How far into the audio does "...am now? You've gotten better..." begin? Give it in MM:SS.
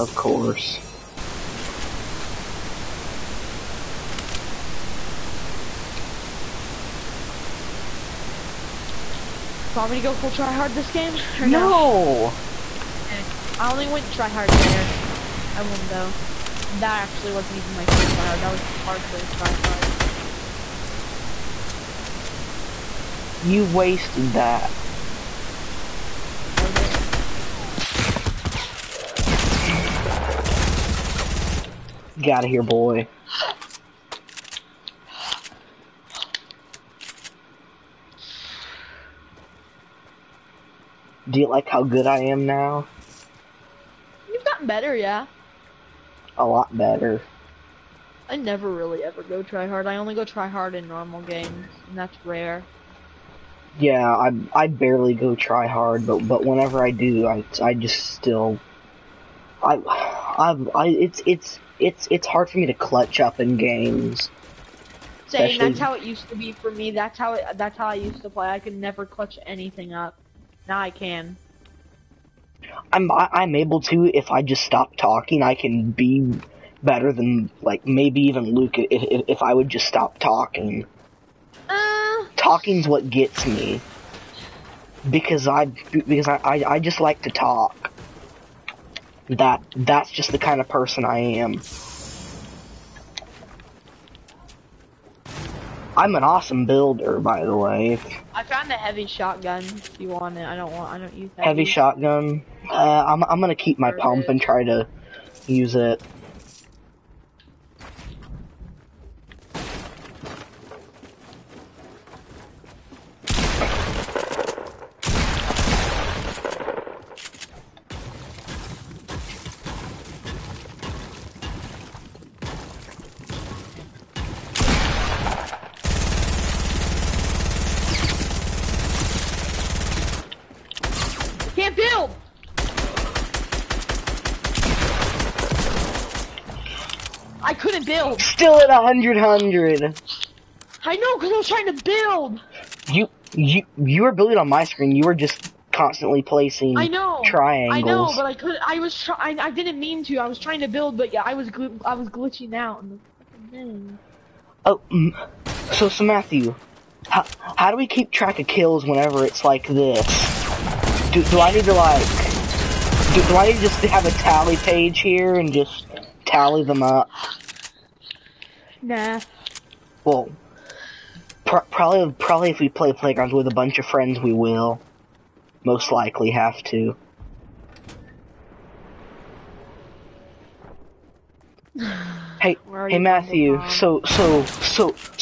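00:42.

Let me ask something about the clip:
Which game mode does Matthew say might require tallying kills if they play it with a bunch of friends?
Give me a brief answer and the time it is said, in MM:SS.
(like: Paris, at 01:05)
Playgrounds, at 02:52.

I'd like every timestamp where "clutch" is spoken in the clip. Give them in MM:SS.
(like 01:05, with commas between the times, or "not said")
01:02, 01:09.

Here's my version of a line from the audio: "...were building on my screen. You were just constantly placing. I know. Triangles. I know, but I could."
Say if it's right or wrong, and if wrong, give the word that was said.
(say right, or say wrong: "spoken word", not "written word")
right.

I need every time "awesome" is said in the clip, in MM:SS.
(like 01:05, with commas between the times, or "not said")
01:36.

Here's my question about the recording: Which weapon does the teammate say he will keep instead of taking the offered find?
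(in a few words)
Pump.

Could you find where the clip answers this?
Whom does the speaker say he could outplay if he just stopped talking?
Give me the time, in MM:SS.
01:18.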